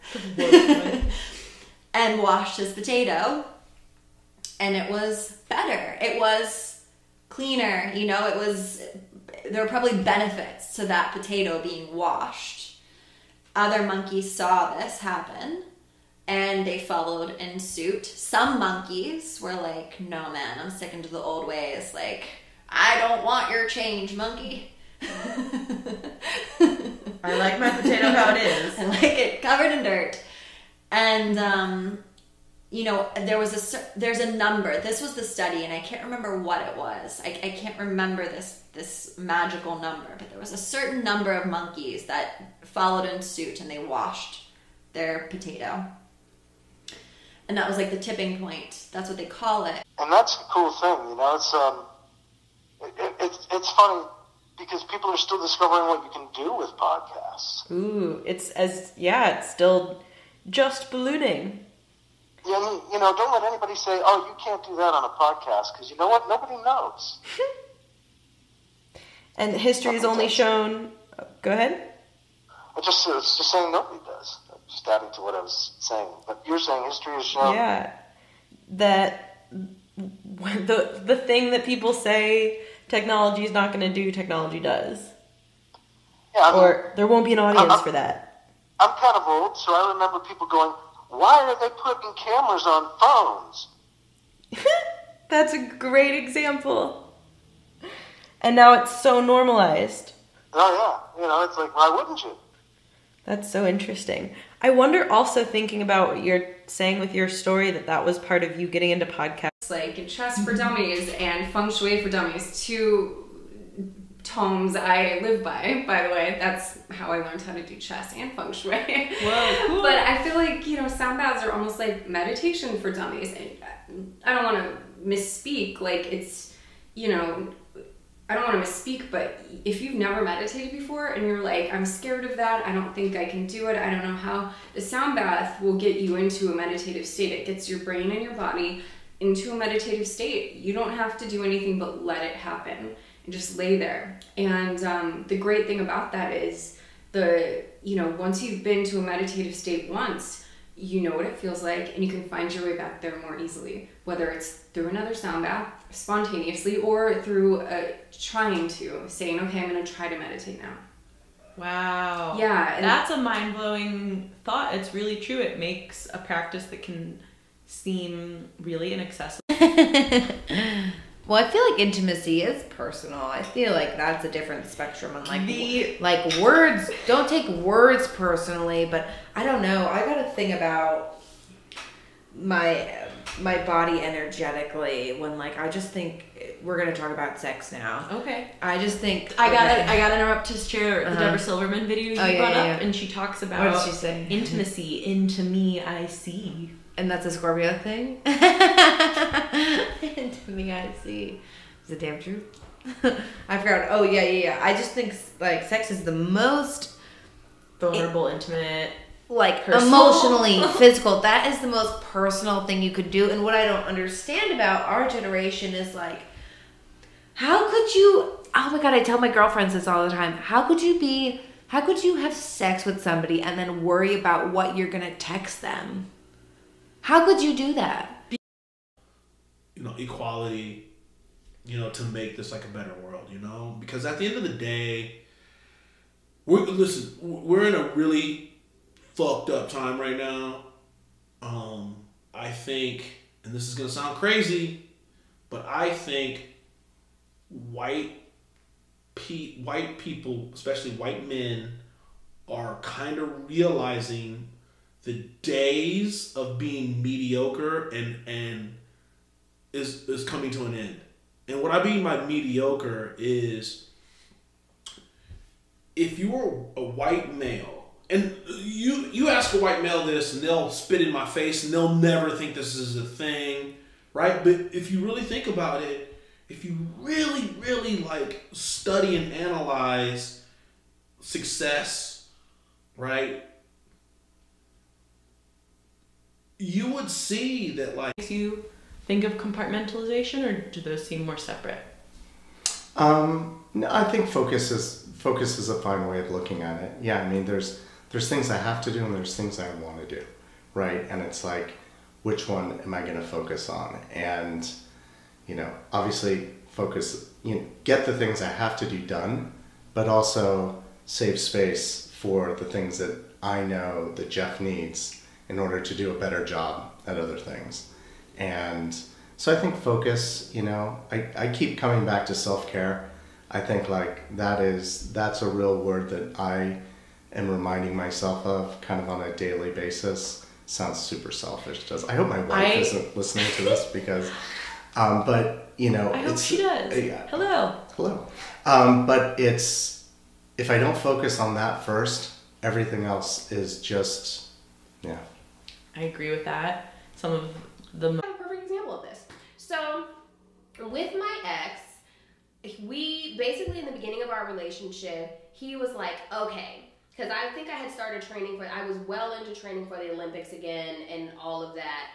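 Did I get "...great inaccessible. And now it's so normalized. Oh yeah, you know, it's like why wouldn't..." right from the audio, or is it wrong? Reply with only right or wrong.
wrong.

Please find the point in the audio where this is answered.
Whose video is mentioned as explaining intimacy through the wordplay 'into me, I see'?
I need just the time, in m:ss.
3:11.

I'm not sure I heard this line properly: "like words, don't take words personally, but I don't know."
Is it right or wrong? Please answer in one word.
right.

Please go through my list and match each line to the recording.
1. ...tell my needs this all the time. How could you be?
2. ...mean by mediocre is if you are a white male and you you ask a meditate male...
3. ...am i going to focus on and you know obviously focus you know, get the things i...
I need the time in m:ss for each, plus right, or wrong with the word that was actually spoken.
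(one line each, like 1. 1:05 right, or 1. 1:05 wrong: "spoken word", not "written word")
1. 3:39 wrong: "girlfriends", not "needs"
2. 4:21 wrong: "white", not "meditate"
3. 5:02 right.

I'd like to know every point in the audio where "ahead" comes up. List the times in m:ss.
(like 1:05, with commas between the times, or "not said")
1:11.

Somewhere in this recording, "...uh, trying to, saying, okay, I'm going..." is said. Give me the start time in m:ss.
2:37.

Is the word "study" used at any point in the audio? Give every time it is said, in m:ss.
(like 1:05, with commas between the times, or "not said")
0:35, 4:38.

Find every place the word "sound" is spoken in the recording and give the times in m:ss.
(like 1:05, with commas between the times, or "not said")
2:00, 2:14, 2:35, 4:03, 5:30.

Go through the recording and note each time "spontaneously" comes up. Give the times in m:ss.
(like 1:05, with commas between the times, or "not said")
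2:35.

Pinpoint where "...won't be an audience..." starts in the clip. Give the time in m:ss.
1:27.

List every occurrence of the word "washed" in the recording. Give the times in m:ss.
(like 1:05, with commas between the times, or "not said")
0:02, 0:11, 0:43.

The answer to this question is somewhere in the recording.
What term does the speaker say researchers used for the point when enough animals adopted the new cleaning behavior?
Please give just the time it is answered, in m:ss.
0:47.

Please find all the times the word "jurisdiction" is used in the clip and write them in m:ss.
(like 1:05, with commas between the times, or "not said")
not said.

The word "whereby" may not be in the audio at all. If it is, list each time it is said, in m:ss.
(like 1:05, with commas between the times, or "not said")
not said.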